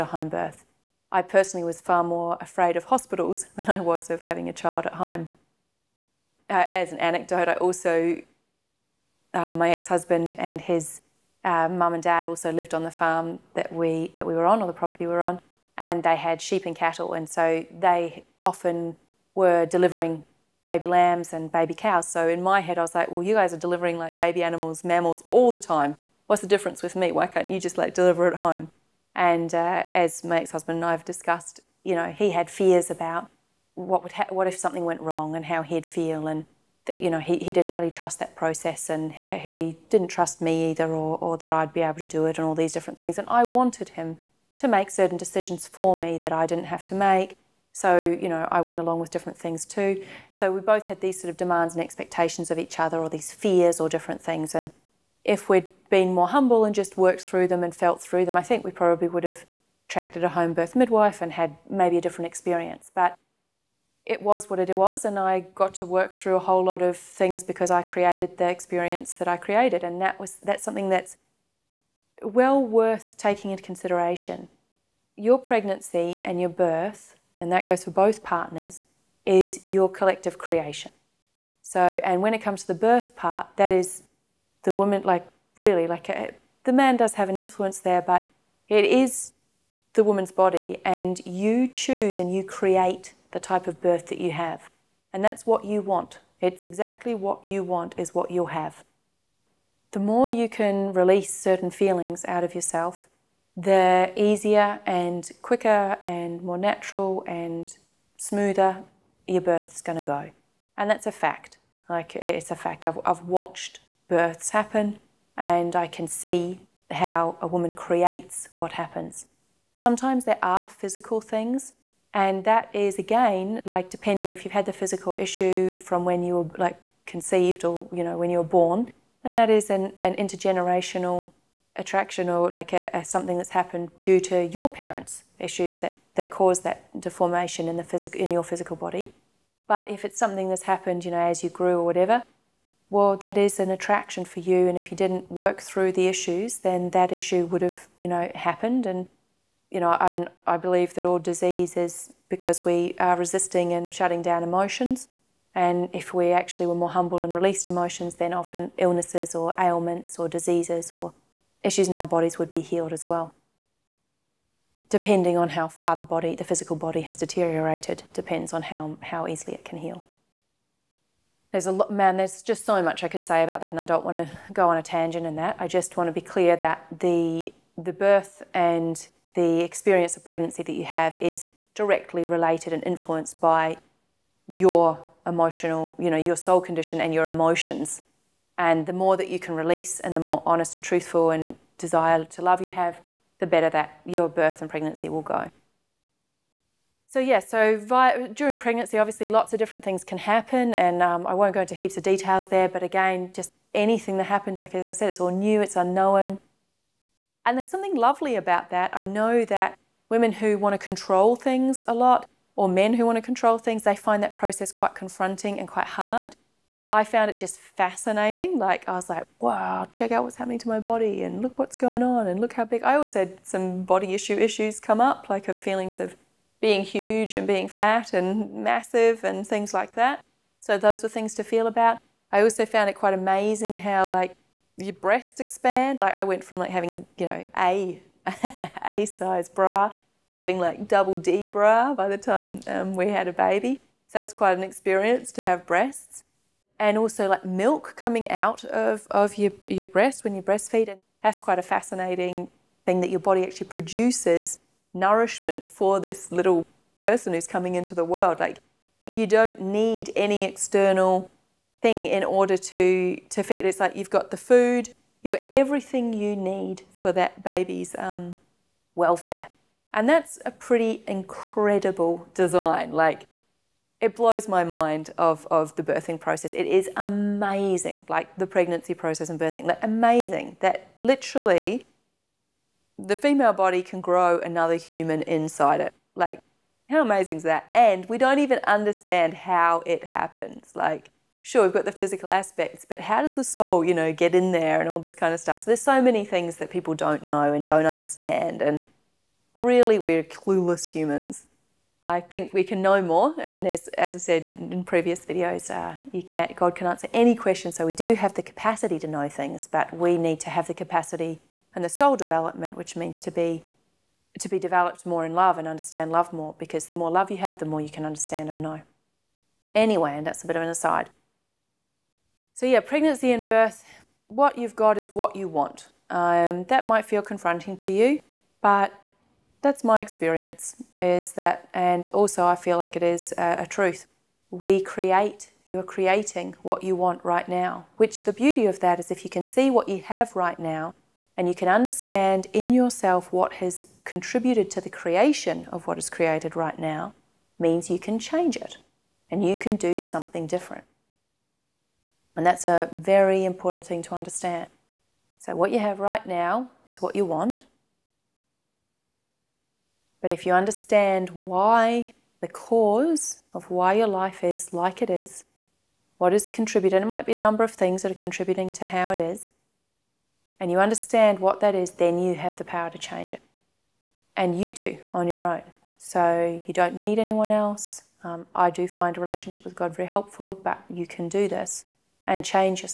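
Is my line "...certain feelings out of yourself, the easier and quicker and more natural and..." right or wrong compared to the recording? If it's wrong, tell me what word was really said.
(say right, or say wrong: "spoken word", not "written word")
right.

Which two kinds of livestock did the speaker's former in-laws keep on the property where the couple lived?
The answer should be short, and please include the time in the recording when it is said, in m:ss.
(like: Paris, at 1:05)
sheep and cattle, at 0:16.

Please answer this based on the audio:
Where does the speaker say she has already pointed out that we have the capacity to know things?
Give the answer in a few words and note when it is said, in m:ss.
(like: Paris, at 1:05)
previous videos, at 5:04.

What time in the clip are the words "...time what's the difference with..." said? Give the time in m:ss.
0:25.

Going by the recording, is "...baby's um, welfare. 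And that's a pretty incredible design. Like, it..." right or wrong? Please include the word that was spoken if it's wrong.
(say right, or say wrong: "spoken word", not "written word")
right.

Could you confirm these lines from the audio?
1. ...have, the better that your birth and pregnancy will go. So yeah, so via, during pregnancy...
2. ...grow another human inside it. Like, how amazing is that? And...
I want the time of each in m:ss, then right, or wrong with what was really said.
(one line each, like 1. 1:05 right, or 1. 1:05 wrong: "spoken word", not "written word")
1. 3:12 right
2. 4:43 right.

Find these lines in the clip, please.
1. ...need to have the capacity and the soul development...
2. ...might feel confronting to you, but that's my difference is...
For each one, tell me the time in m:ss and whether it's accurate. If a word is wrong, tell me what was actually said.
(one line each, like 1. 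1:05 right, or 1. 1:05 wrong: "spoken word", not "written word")
1. 5:10 right
2. 5:26 wrong: "experience", not "difference".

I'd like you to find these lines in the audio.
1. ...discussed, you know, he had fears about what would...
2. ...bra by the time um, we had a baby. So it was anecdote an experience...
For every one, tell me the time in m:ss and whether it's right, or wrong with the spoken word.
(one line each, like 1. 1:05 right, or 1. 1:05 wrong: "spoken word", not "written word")
1. 0:31 right
2. 4:01 wrong: "quite", not "anecdote".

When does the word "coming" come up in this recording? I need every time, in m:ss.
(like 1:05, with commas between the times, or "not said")
4:07, 4:17.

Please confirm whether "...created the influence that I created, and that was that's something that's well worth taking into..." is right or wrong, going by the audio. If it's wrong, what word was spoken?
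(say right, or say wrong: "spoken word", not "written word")
wrong: "experience", not "influence".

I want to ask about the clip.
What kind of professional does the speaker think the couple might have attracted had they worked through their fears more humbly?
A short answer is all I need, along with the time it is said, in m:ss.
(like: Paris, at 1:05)
home birth midwife, at 1:00.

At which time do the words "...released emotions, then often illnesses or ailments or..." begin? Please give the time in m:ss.
2:37.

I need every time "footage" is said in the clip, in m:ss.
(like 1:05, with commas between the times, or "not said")
not said.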